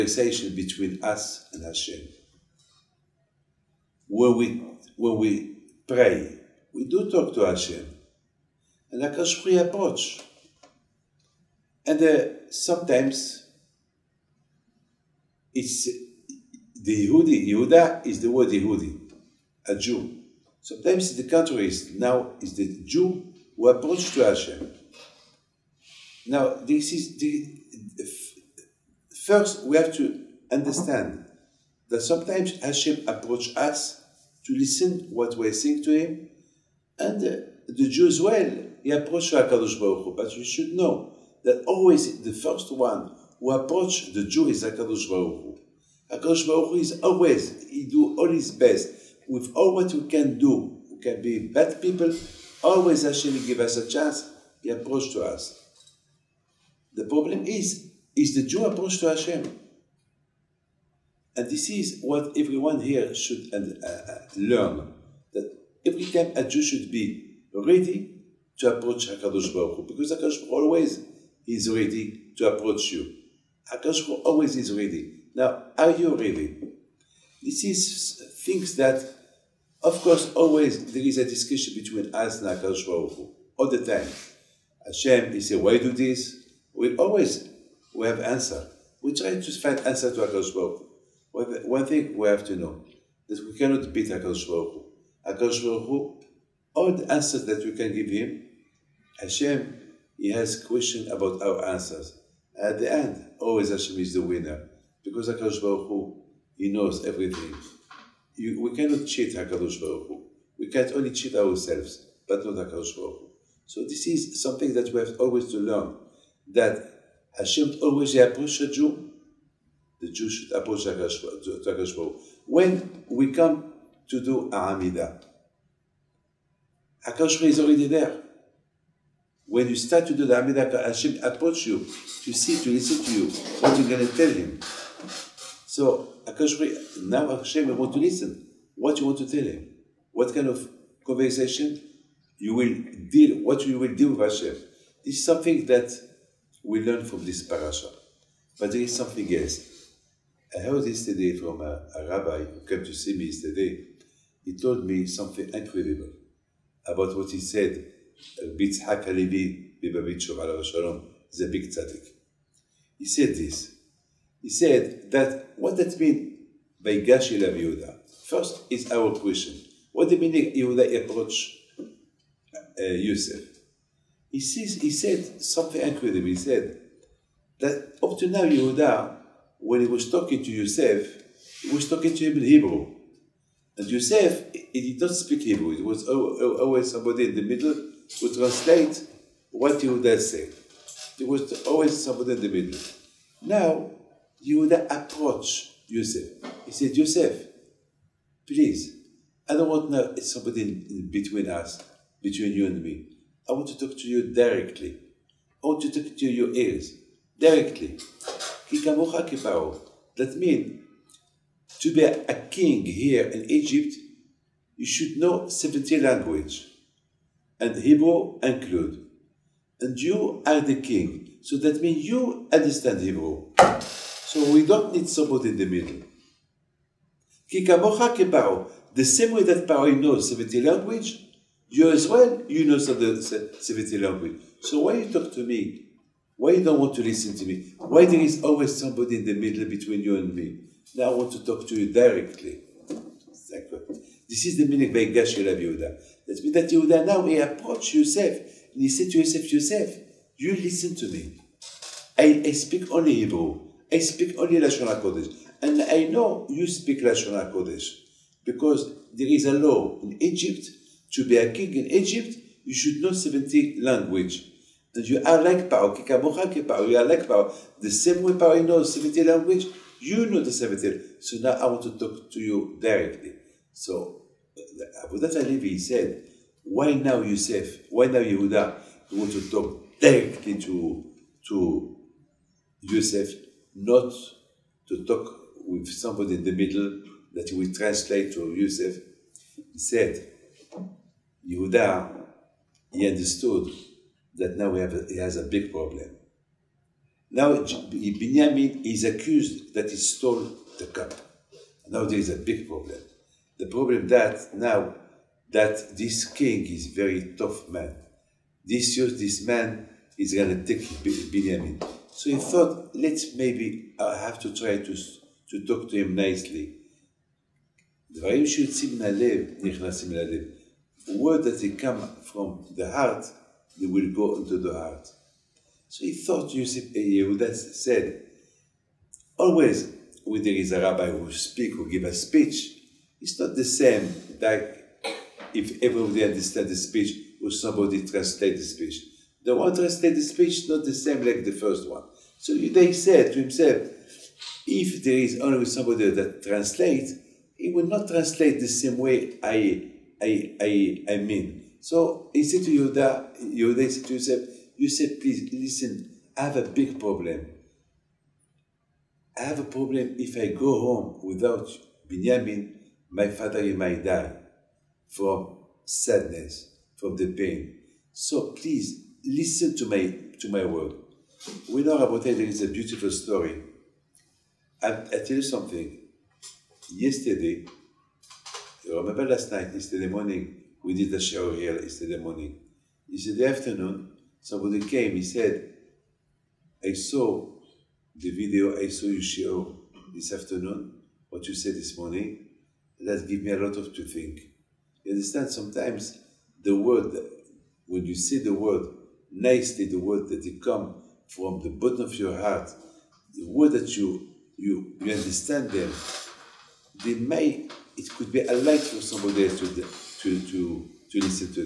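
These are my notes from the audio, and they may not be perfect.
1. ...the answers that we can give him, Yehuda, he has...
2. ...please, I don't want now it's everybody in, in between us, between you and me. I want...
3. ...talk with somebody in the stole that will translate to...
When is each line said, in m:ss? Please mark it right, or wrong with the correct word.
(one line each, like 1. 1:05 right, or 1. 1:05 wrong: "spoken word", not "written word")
1. 1:36 wrong: "Hashem", not "Yehuda"
2. 3:18 wrong: "somebody", not "everybody"
3. 4:45 wrong: "middle", not "stole".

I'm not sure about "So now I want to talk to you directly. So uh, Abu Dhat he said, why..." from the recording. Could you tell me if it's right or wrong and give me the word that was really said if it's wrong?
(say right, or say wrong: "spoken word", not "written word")
right.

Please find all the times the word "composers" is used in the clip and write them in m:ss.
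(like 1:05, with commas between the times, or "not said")
not said.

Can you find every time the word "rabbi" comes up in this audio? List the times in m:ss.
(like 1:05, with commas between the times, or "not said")
2:32, 5:30.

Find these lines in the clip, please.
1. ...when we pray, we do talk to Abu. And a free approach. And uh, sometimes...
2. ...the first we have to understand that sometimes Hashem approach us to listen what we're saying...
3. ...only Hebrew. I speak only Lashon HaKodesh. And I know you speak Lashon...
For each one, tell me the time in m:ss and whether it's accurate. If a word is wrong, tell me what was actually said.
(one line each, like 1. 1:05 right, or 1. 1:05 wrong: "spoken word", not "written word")
1. 0:04 wrong: "Hashem", not "Abu"
2. 0:27 right
3. 4:12 right.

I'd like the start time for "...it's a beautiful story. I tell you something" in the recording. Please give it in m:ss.
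6:12.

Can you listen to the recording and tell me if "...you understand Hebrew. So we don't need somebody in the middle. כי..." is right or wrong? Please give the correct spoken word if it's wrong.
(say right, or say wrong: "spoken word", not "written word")
right.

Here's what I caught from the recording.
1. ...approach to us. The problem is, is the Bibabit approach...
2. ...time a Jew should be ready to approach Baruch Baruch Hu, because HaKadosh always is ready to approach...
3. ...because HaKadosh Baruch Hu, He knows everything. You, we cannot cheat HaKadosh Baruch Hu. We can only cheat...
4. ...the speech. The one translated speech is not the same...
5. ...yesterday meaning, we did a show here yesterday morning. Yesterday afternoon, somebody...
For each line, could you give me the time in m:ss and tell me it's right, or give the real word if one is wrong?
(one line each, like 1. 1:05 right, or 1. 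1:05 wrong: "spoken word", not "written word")
1. 0:54 wrong: "Jew", not "Bibabit"
2. 1:06 wrong: "HaKadosh", not "Baruch"
3. 1:45 right
4. 5:38 right
5. 6:19 wrong: "morning", not "meaning".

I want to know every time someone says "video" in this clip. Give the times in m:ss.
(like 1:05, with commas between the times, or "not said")
6:28.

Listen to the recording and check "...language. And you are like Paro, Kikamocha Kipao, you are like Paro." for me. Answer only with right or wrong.
right.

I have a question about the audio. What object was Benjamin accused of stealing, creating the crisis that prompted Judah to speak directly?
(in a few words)
The cup.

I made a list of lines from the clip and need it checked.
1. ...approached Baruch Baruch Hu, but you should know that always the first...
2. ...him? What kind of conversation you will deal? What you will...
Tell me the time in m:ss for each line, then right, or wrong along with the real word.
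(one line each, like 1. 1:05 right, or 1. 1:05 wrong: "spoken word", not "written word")
1. 0:38 wrong: "Hakadosh", not "Baruch"
2. 2:19 right.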